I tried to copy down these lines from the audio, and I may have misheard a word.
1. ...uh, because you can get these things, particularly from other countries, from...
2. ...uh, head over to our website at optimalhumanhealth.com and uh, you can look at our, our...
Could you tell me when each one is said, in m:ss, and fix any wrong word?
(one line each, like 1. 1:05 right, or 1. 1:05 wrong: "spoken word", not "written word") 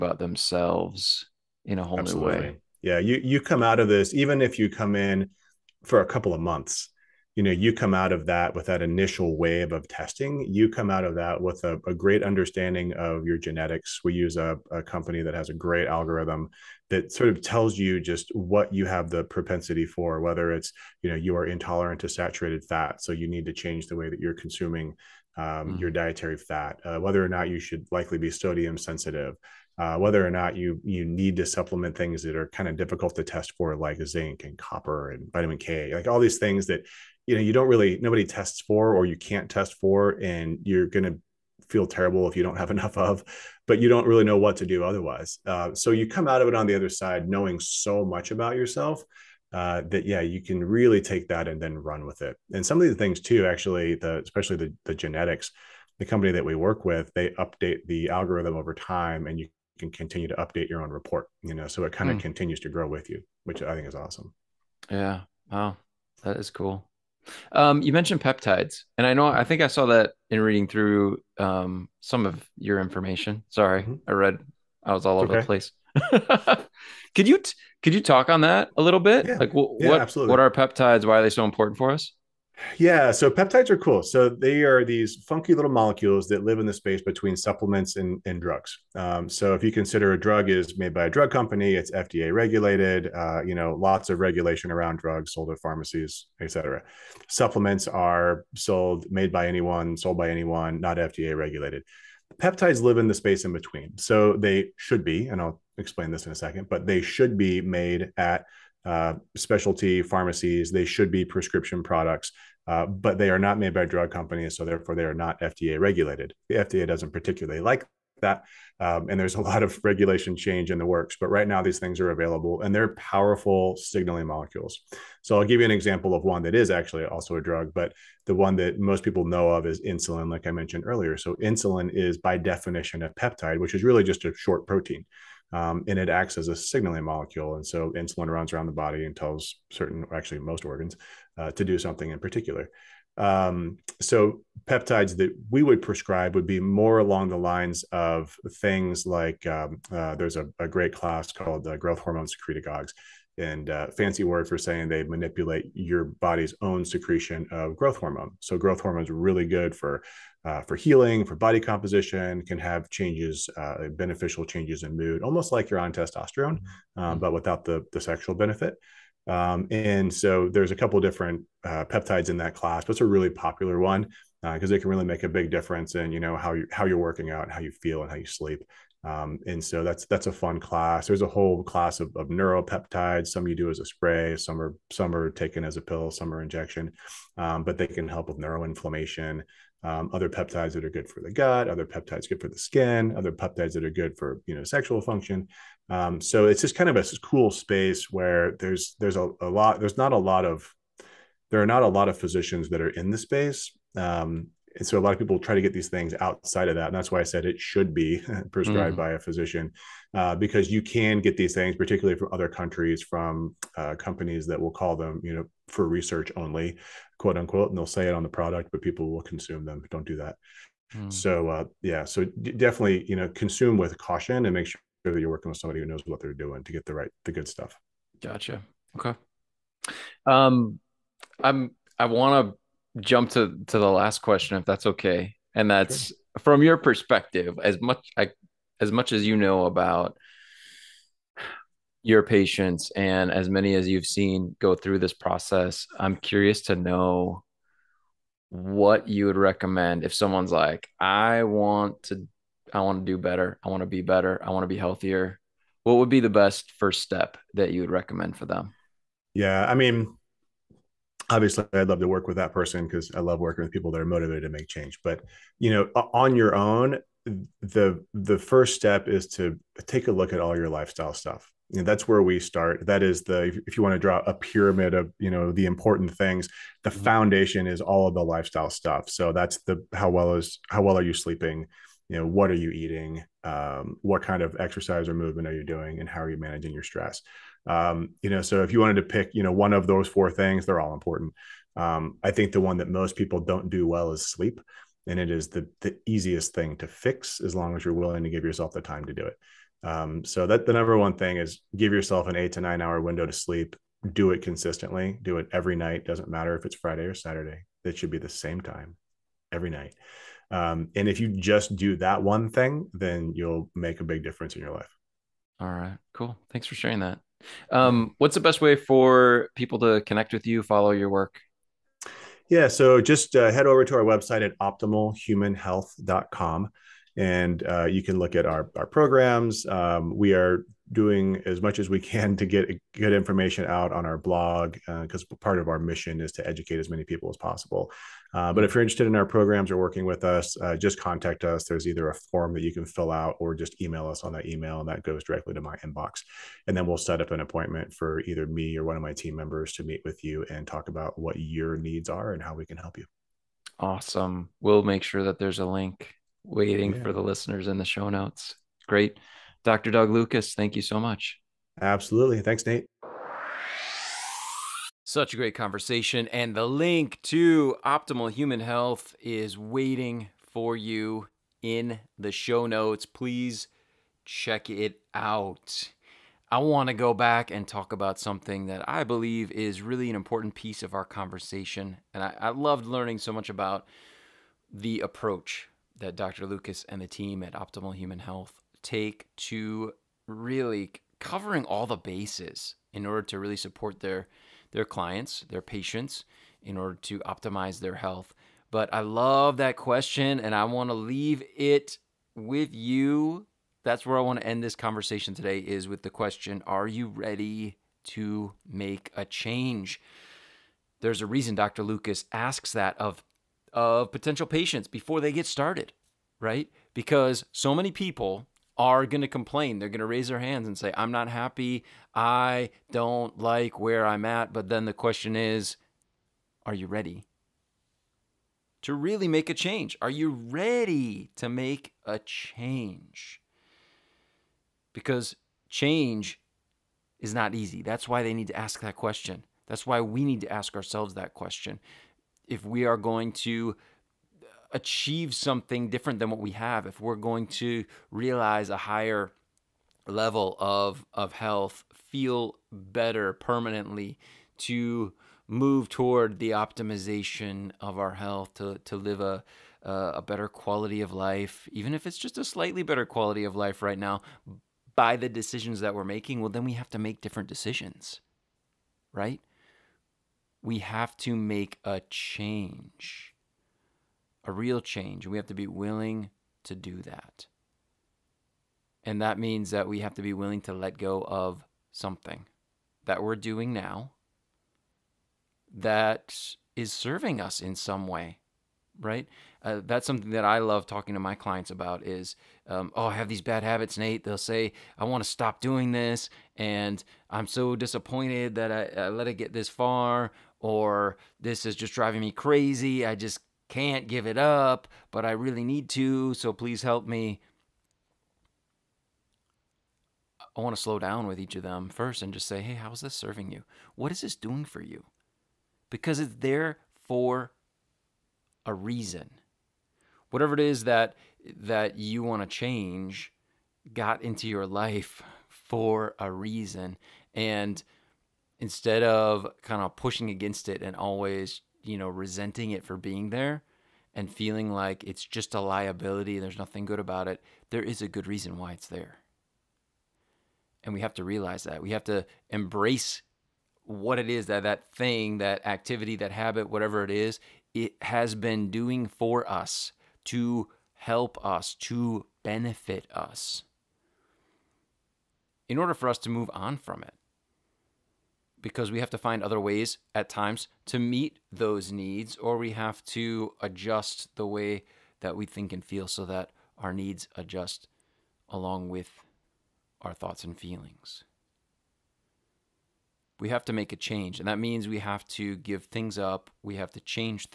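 1. 3:30 right
2. 5:23 right.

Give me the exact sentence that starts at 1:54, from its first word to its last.
So therefore, they are not FDA regulated.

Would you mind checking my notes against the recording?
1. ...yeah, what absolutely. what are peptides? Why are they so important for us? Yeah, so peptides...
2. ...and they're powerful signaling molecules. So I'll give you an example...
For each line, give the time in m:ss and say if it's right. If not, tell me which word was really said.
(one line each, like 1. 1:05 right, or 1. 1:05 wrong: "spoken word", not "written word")
1. 1:19 right
2. 2:02 right.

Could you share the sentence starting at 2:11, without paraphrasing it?
So insulin is by definition a peptide, which is really just a short protein um, and it acts as a signaling molecule.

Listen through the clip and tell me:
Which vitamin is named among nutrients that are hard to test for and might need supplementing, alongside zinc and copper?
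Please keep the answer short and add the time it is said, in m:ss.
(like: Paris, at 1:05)
vitamin K, at 0:35.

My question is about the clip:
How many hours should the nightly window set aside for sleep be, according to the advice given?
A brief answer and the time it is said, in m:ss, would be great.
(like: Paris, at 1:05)
8 to 9, at 5:02.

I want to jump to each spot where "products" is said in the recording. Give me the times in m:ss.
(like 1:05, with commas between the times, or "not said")
1:51, 3:38.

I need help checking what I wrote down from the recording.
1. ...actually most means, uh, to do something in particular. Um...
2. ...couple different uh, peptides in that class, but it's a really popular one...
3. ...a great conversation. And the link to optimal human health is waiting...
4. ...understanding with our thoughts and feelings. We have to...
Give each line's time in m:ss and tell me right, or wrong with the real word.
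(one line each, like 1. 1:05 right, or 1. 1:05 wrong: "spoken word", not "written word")
1. 2:20 wrong: "organs", not "means"
2. 2:50 right
3. 6:05 right
4. 9:28 wrong: "along", not "understanding".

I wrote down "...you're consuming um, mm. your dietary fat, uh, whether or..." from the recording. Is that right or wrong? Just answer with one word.
right.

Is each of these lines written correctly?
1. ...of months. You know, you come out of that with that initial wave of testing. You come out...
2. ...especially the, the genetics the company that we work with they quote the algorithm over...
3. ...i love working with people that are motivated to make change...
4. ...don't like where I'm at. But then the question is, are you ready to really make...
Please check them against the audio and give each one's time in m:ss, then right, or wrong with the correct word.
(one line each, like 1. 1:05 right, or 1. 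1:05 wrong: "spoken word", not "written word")
1. 0:06 right
2. 0:54 wrong: "update", not "quote"
3. 4:23 right
4. 7:02 right.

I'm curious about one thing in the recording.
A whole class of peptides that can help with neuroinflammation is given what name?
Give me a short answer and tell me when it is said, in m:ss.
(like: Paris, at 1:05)
neuropeptides, at 3:02.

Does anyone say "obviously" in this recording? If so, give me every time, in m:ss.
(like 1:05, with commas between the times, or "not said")
4:21.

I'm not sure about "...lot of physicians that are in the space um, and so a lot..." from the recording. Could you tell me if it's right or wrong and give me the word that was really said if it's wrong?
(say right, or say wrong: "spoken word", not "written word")
right.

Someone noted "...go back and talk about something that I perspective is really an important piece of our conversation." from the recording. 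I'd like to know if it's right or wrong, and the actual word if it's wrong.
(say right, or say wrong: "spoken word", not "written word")
wrong: "believe", not "perspective".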